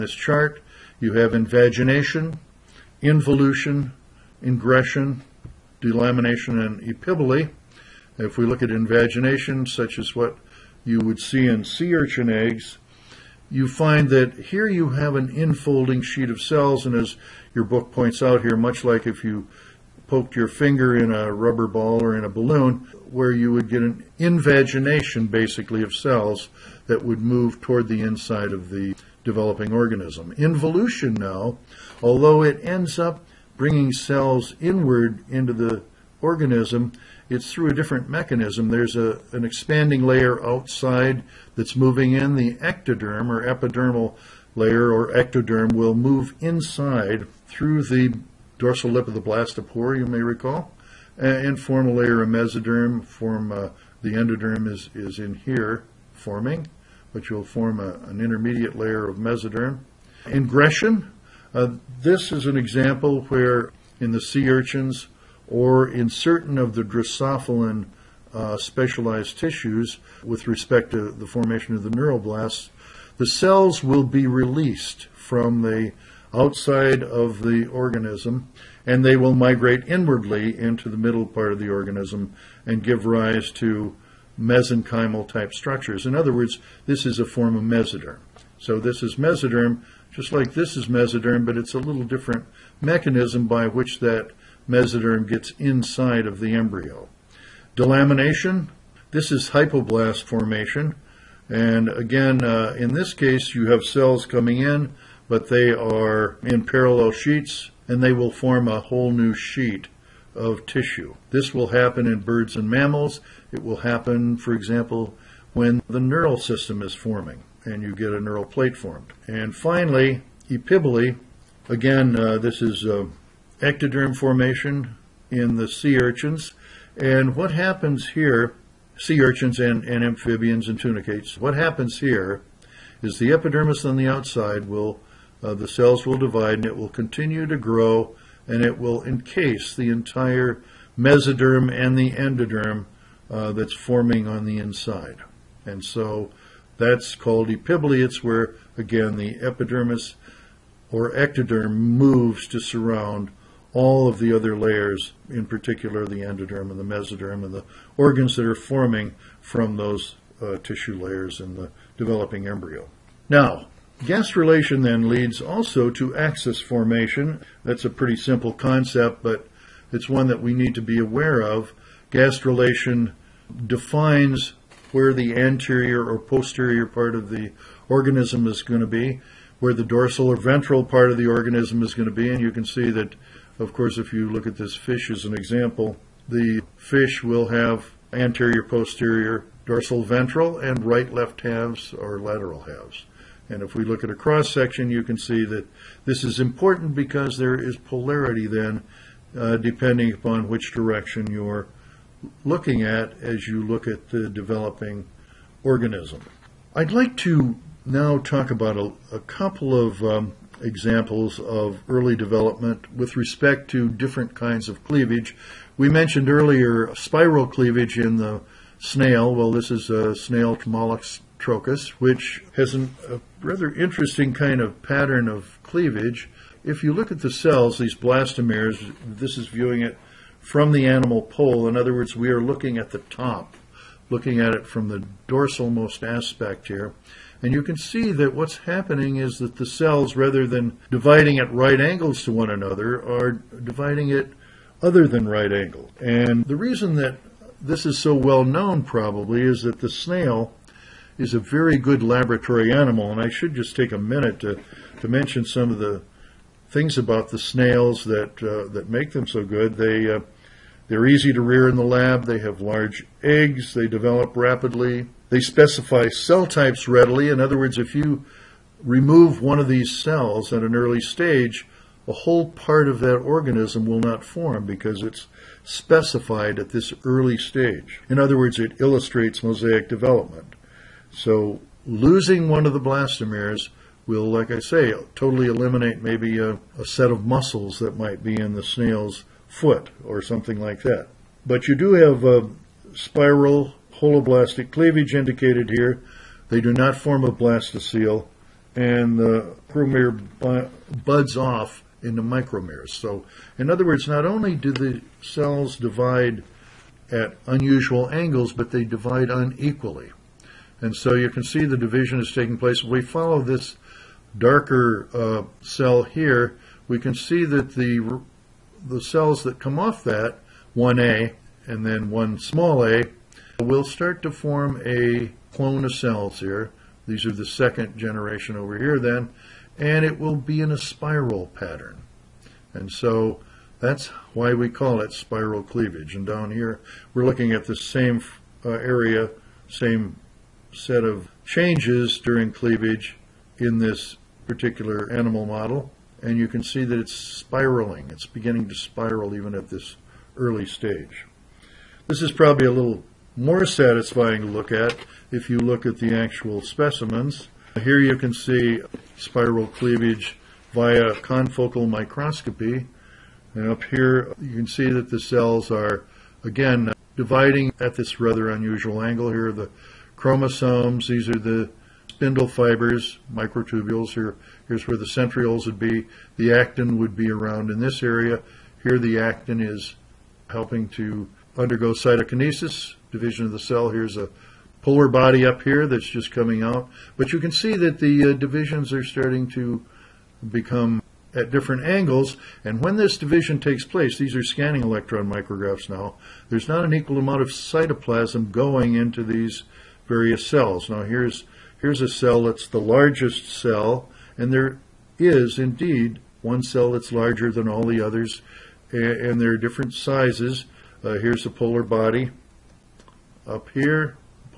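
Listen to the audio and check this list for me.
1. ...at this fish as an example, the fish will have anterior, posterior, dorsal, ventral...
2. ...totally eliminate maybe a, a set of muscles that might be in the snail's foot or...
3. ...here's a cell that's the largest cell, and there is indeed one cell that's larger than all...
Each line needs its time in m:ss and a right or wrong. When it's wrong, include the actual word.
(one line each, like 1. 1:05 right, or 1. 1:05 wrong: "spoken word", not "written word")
1. 3:04 right
2. 4:45 right
3. 6:41 right.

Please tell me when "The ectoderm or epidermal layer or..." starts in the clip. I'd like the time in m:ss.
0:42.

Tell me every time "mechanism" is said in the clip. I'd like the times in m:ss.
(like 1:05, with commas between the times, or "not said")
0:38, 1:32.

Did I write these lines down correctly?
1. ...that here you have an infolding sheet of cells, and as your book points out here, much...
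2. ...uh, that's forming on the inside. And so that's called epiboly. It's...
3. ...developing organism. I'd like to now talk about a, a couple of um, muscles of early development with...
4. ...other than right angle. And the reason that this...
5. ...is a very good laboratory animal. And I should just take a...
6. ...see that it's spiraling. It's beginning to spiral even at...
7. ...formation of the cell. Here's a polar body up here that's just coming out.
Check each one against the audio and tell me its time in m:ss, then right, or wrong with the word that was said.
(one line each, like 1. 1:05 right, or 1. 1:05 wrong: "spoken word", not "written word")
1. 0:14 right
2. 2:23 right
3. 3:24 wrong: "examples", not "muscles"
4. 4:04 right
5. 4:11 right
6. 5:46 right
7. 6:23 wrong: "division", not "formation".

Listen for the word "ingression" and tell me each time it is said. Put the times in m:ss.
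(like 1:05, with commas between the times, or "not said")
0:04, 1:00.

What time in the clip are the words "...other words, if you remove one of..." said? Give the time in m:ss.
4:27.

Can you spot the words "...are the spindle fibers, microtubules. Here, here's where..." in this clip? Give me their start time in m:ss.
6:11.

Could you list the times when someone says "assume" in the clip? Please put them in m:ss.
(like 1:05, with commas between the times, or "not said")
not said.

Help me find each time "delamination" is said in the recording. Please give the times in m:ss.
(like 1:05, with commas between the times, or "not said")
0:05, 1:37.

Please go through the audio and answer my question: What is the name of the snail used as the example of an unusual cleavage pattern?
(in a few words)
Trochus.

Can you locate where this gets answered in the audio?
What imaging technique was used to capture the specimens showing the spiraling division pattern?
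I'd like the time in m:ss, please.
6:01.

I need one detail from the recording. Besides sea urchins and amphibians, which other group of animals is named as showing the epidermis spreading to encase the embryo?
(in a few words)
Tunicates.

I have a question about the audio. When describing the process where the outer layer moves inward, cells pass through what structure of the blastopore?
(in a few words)
The dorsal lip.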